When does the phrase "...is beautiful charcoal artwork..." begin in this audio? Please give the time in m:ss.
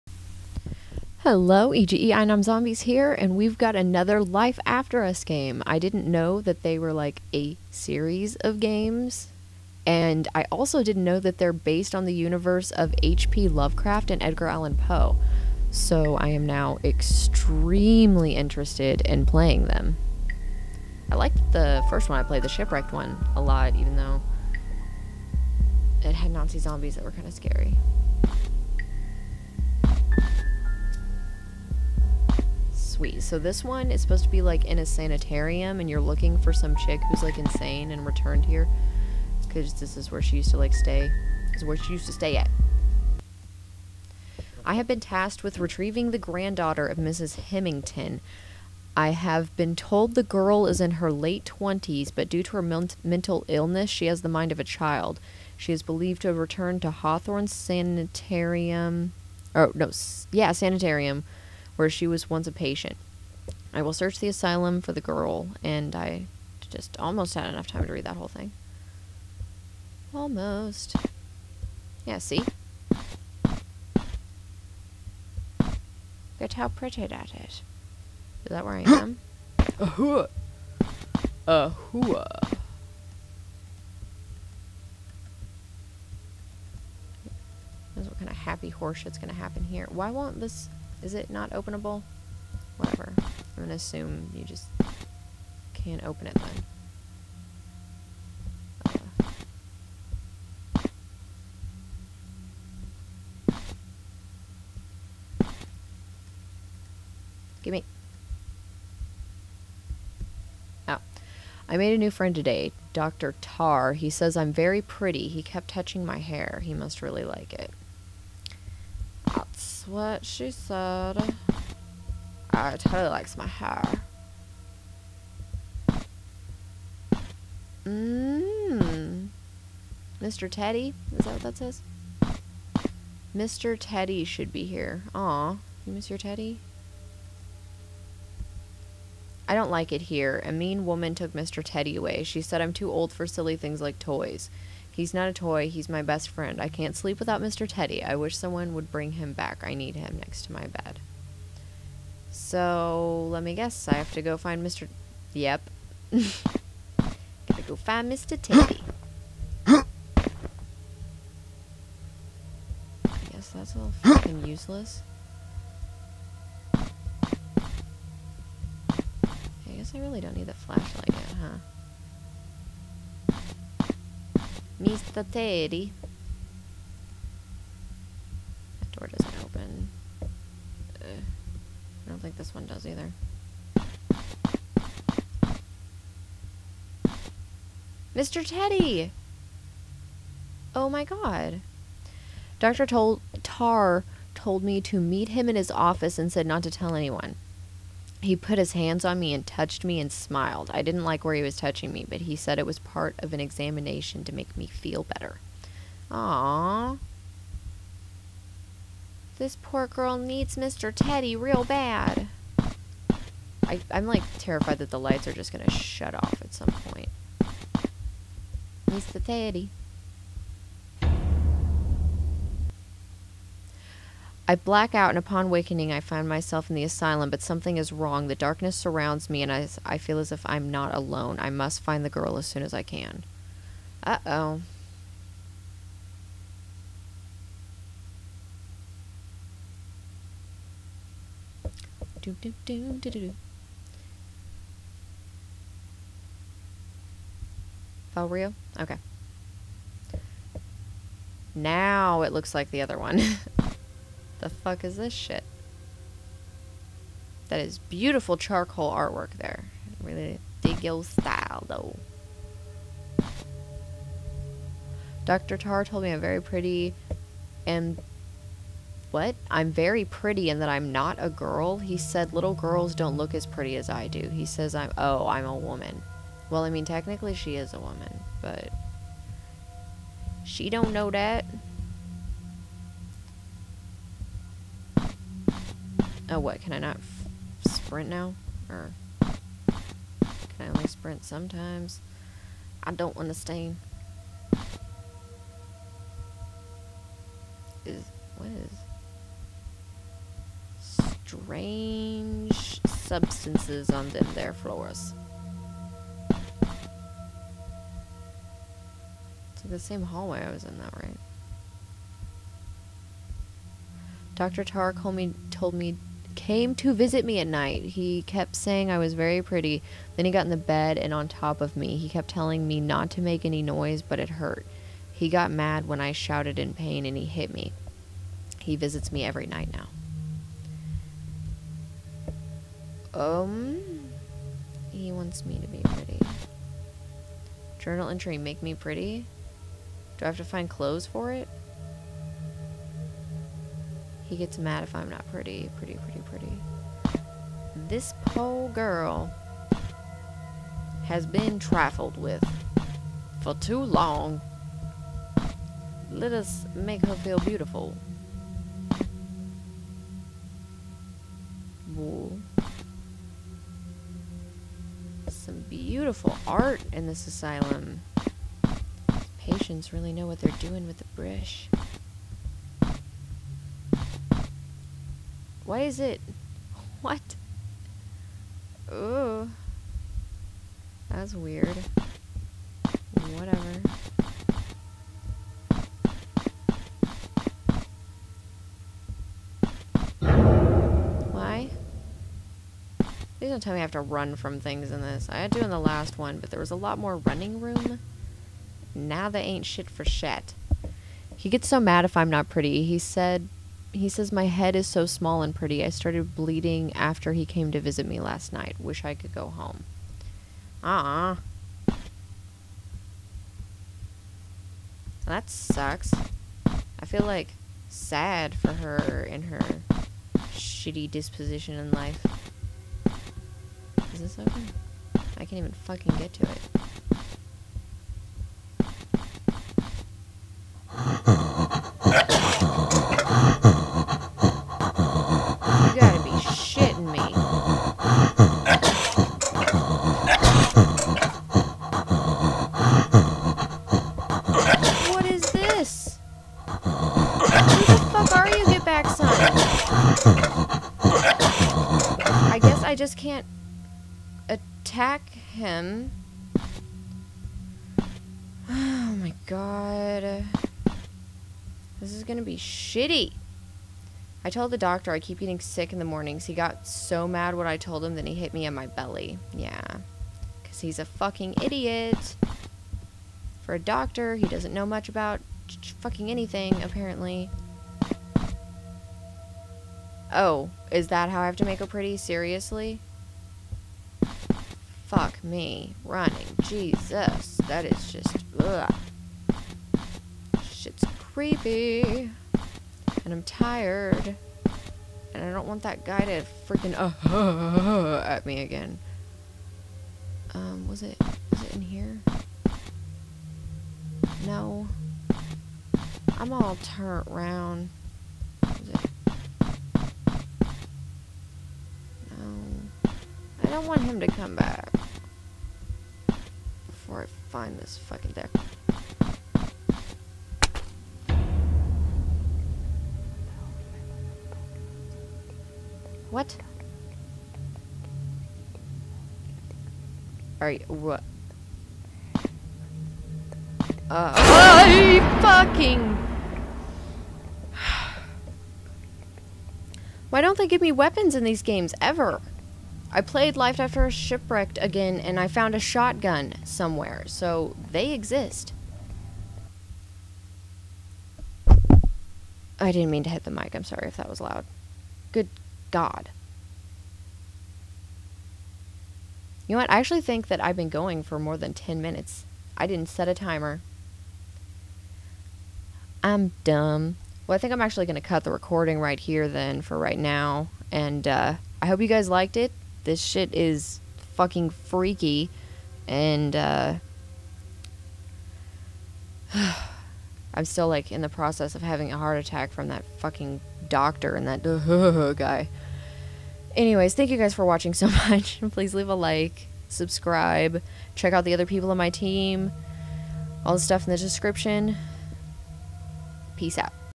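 4:17.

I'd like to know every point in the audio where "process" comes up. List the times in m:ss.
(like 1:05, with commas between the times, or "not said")
9:41.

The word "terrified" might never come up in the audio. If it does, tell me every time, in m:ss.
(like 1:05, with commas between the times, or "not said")
3:34.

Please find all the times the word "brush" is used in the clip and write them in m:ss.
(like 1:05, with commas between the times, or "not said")
6:11.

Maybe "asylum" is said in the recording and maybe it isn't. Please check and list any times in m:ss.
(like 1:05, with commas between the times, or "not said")
1:04, 3:46, 6:07.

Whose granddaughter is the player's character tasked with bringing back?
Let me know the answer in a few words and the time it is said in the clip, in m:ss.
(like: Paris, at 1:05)
Mrs. Hemington, at 0:46.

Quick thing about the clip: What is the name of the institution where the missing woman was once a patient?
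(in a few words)
Hawthorne Sanitarium.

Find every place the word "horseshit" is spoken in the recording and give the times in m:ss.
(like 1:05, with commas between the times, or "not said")
1:28.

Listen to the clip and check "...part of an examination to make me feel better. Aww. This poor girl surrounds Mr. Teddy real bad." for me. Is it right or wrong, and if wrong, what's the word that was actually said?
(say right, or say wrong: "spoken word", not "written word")
wrong: "needs", not "surrounds".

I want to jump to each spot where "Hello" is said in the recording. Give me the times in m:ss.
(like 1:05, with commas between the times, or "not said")
0:01.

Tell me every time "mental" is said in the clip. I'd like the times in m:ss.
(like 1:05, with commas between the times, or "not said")
0:53.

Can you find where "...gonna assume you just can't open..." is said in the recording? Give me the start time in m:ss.
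1:33.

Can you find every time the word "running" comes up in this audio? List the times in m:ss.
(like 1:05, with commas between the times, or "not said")
6:37, 8:06.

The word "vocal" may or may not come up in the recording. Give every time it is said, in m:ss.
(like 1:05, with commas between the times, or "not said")
not said.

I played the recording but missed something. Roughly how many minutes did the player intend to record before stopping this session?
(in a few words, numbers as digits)
10.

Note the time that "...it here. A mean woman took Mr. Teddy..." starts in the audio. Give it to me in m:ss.
2:19.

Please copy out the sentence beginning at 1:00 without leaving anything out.
Yeah, Sanitarium where she was once a patient.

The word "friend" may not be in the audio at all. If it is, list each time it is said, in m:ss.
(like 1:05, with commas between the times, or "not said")
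1:52, 2:26.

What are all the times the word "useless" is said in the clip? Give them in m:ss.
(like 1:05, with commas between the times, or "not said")
2:44.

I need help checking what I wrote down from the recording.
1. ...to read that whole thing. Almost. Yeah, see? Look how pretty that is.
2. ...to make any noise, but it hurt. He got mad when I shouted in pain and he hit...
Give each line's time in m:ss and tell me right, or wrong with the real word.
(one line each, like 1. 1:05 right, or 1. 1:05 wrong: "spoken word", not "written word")
1. 1:07 right
2. 5:23 right.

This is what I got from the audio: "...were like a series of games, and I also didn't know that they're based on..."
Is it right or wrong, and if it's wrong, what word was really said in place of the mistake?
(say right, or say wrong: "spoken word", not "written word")
right.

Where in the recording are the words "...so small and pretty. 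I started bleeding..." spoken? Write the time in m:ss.
6:44.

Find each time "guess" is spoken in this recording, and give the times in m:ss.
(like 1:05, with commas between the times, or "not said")
2:33, 2:43, 2:49.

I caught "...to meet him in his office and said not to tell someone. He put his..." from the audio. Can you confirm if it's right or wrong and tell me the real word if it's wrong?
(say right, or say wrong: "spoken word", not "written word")
wrong: "anyone", not "someone".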